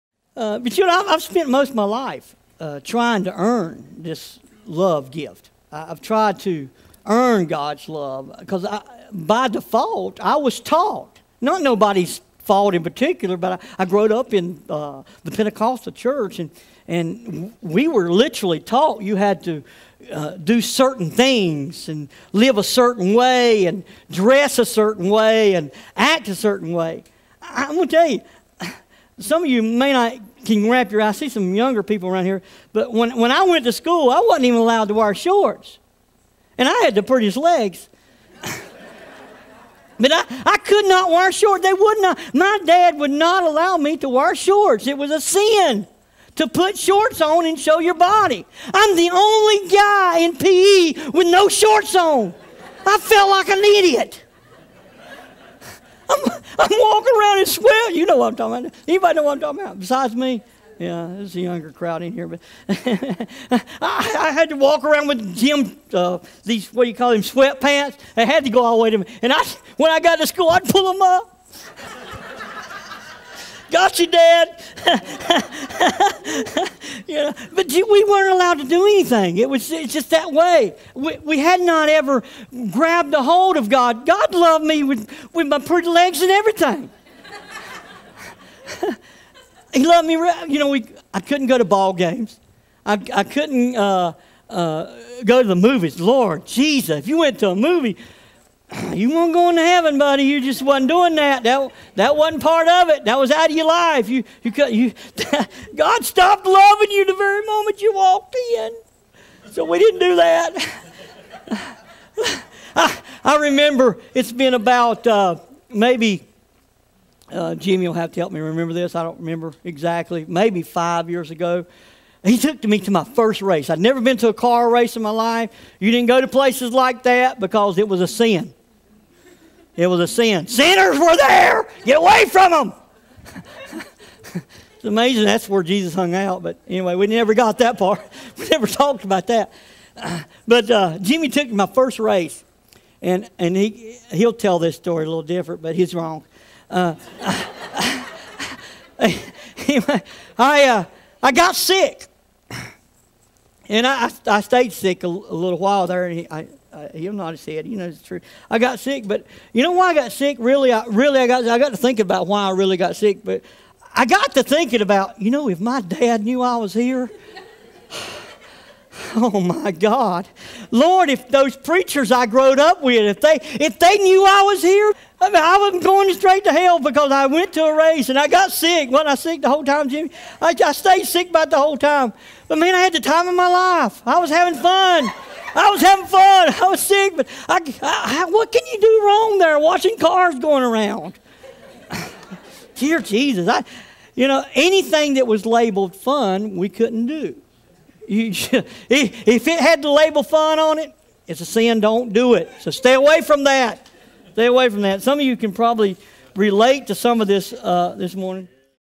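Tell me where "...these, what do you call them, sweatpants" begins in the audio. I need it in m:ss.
1:06.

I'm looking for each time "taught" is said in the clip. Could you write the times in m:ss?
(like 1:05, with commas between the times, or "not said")
0:10, 0:18.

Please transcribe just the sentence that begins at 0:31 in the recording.
I see some younger people around here, but when, when I went to school, I wasn't even allowed to wear shorts.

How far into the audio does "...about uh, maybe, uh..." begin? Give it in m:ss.
1:54.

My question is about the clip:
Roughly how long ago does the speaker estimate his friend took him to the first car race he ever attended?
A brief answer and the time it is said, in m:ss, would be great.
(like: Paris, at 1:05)
5 years, at 2:00.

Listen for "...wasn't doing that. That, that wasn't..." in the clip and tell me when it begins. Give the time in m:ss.
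1:40.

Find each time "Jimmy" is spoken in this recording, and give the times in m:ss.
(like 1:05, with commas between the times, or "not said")
1:57, 2:20, 2:59.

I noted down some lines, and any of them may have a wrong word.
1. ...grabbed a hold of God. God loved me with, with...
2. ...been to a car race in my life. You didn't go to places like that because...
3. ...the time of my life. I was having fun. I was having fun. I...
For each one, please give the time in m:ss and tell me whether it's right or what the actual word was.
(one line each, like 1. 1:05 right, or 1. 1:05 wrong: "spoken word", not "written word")
1. 1:22 right
2. 2:03 right
3. 3:02 right.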